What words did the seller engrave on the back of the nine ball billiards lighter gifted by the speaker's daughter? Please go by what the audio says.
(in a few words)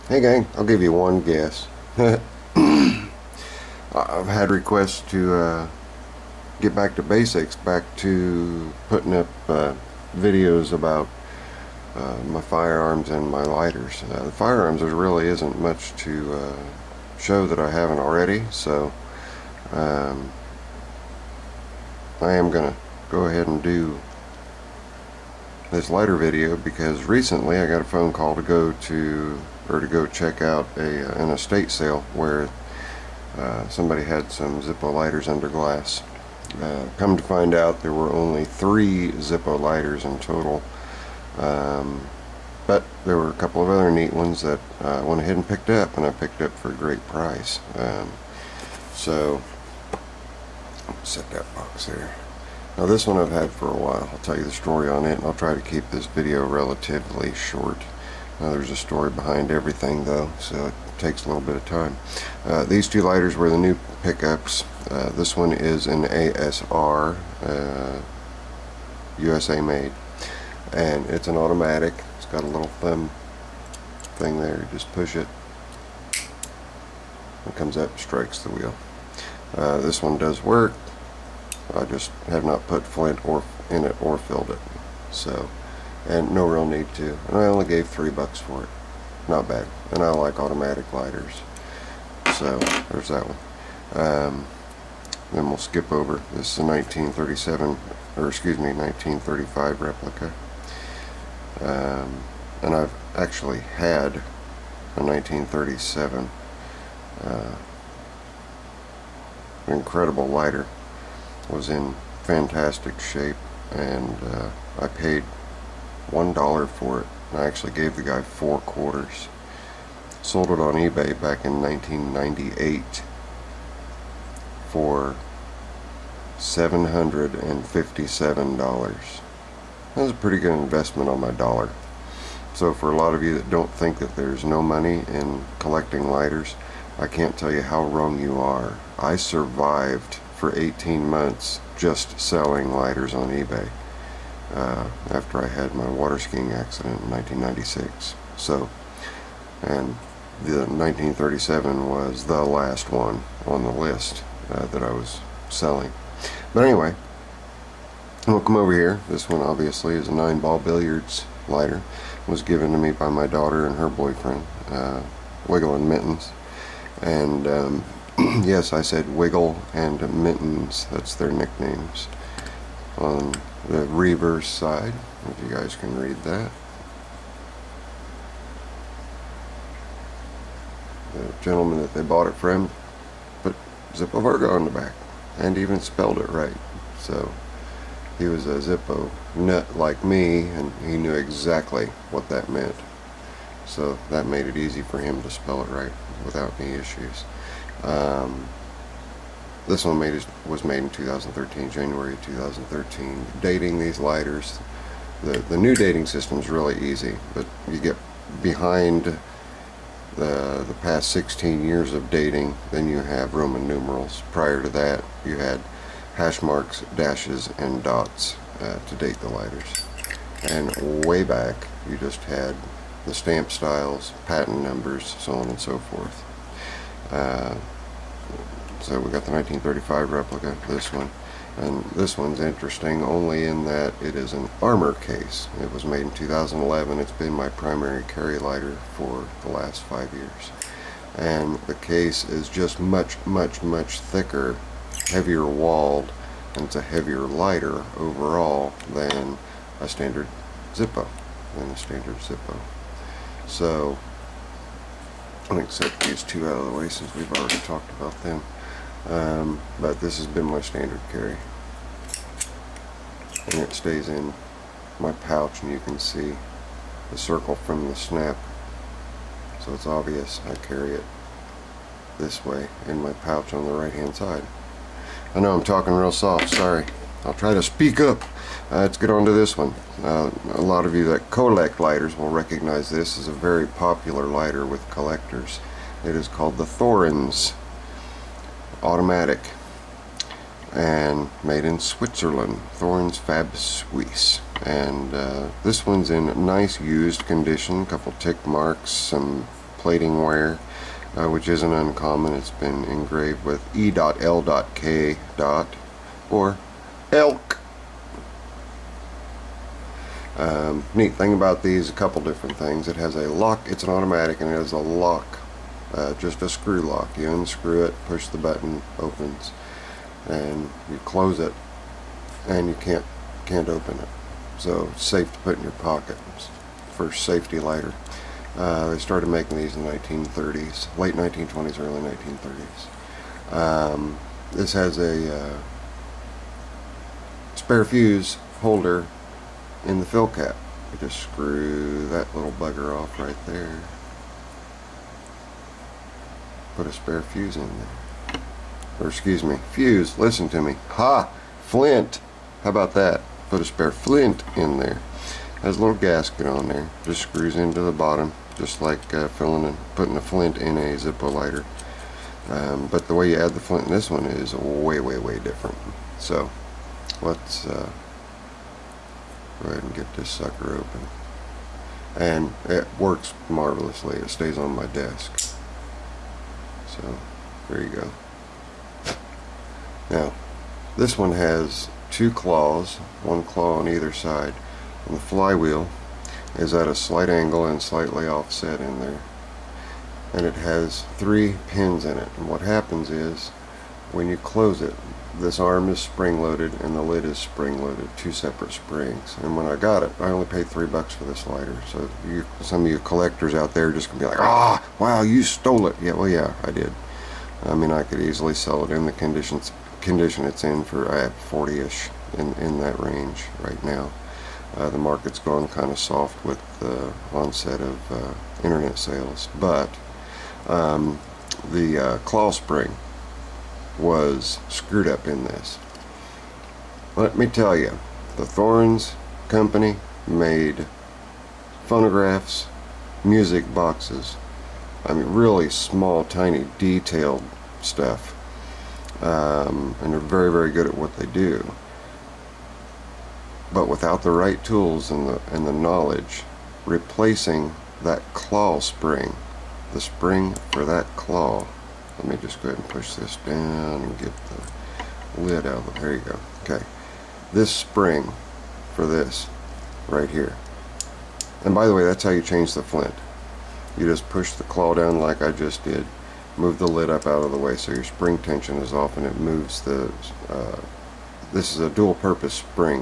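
Zippo Varga.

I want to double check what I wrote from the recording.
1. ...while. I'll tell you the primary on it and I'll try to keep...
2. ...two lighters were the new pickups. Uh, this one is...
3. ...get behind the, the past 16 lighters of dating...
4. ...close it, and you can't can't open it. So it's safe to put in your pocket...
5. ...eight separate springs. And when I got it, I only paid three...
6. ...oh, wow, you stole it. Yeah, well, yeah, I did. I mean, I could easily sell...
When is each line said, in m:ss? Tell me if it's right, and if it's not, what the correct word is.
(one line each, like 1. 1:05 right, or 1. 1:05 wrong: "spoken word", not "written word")
1. 0:53 wrong: "story", not "primary"
2. 1:02 right
3. 3:27 wrong: "years", not "lighters"
4. 5:21 right
5. 6:38 wrong: "two", not "eight"
6. 6:44 right.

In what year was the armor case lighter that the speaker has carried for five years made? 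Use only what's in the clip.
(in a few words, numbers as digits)
2011.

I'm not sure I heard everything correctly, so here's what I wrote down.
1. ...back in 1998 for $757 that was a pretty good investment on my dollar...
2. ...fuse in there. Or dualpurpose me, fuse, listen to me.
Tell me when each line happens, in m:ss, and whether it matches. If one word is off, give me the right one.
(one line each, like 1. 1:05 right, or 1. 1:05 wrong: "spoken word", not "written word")
1. 2:01 right
2. 5:47 wrong: "excuse", not "dualpurpose".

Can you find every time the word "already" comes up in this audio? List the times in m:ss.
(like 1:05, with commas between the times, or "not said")
0:17, 4:17.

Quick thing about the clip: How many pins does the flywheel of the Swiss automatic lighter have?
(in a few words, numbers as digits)
3.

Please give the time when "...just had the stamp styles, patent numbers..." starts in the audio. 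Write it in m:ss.
3:41.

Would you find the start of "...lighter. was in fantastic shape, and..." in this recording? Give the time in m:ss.
1:50.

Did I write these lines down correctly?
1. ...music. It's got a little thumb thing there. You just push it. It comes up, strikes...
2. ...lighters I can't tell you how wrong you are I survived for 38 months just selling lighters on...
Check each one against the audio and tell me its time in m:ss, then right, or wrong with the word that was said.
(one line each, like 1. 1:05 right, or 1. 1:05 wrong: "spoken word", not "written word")
1. 1:11 wrong: "automatic", not "music"
2. 2:16 wrong: "18", not "38".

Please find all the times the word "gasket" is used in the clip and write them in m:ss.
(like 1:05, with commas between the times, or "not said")
5:55.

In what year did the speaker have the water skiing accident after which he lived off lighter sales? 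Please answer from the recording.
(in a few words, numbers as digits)
1996.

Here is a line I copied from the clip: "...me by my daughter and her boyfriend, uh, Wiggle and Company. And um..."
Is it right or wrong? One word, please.
wrong.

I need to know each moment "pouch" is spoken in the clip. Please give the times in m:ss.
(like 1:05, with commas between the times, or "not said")
4:25, 4:33.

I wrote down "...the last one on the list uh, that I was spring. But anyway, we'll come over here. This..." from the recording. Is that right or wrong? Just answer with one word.
wrong.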